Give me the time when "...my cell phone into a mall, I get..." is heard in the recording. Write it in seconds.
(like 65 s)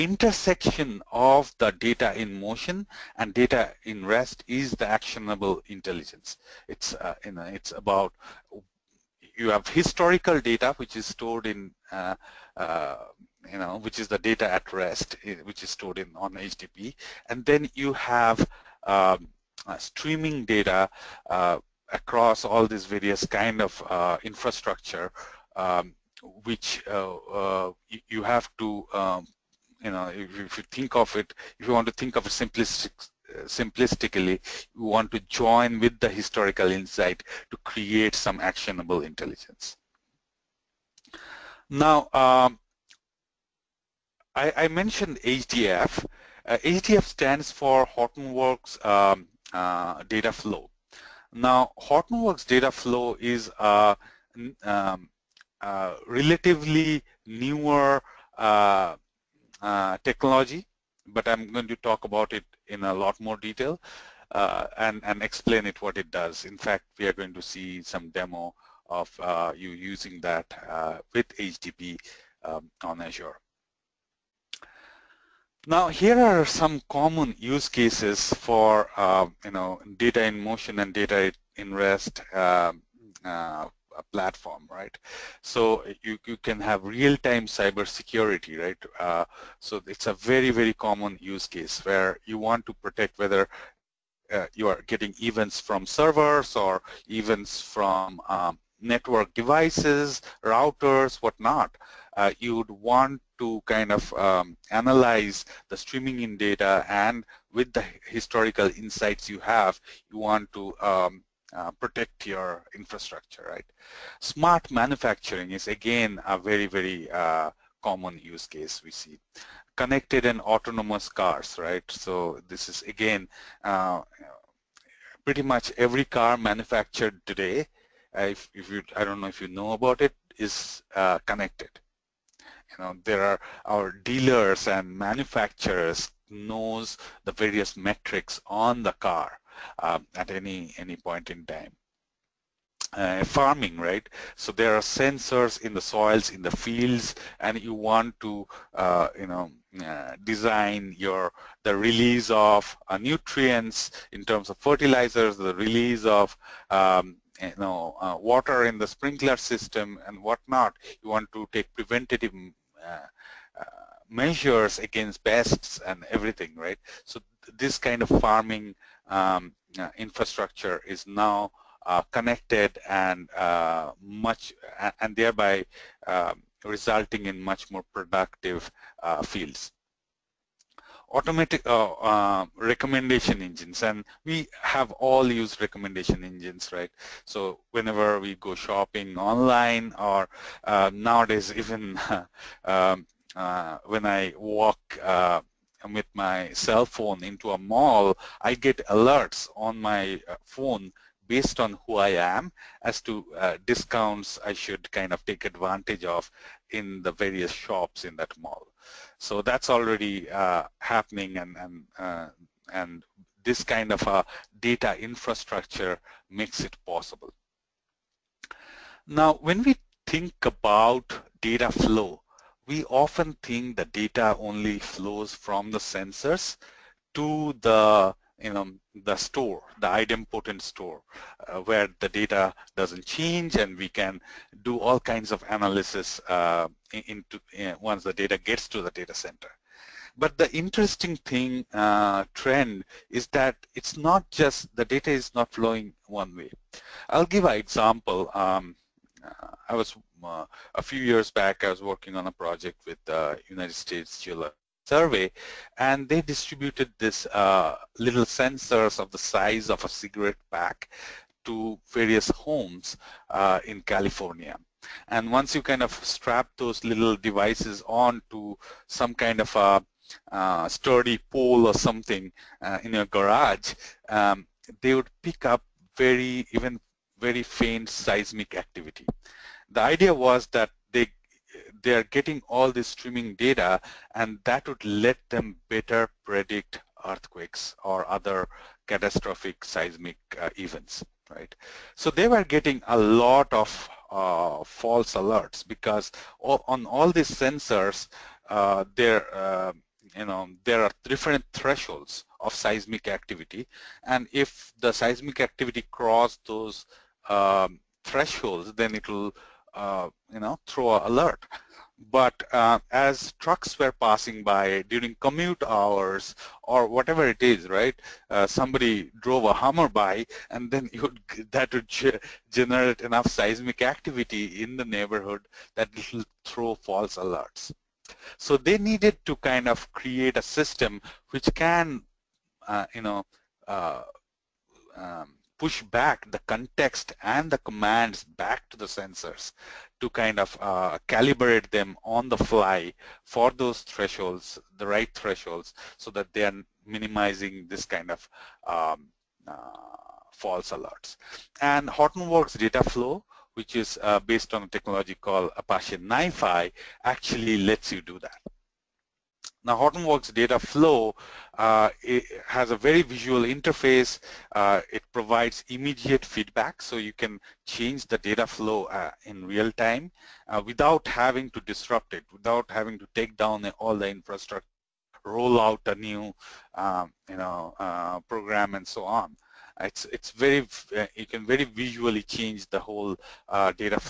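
196 s.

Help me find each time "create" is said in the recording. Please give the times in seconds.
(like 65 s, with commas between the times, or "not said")
37 s, 329 s.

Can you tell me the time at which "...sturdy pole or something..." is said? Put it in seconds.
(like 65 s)
270 s.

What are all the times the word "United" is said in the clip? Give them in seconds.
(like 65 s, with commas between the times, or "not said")
253 s.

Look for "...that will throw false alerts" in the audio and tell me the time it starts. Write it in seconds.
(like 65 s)
325 s.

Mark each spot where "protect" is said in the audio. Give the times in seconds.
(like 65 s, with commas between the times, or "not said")
92 s, 111 s.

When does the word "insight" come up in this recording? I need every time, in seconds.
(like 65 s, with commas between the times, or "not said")
36 s, 108 s.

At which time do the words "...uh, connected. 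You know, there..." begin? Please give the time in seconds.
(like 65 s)
130 s.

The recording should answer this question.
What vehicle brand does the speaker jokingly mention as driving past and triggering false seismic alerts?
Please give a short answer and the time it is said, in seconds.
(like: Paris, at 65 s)
Hummer, at 319 s.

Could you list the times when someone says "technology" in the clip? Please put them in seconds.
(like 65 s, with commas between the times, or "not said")
60 s, 354 s.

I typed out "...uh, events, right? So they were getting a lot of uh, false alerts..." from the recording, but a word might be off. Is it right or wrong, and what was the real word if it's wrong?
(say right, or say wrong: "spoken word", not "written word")
right.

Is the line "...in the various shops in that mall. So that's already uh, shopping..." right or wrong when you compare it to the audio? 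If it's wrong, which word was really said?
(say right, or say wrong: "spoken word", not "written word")
wrong: "happening", not "shopping".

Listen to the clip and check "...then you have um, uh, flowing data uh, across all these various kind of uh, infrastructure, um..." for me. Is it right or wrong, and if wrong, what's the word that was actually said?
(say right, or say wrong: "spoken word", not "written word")
wrong: "streaming", not "flowing".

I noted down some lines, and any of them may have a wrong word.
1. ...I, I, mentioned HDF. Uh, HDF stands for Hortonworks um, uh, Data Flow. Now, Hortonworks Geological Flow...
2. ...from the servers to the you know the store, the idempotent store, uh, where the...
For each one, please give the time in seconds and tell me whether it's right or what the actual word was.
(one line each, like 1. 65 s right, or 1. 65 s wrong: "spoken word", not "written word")
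1. 44 s wrong: "Data", not "Geological"
2. 225 s wrong: "sensors", not "servers".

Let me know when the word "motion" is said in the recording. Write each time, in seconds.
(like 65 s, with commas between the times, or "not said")
2 s, 80 s.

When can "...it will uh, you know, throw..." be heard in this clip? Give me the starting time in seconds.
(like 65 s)
308 s.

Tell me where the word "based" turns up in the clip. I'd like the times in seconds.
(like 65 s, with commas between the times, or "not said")
201 s, 354 s.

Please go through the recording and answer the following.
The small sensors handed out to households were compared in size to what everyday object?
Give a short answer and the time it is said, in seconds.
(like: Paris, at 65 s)
A cigarette pack, at 259 s.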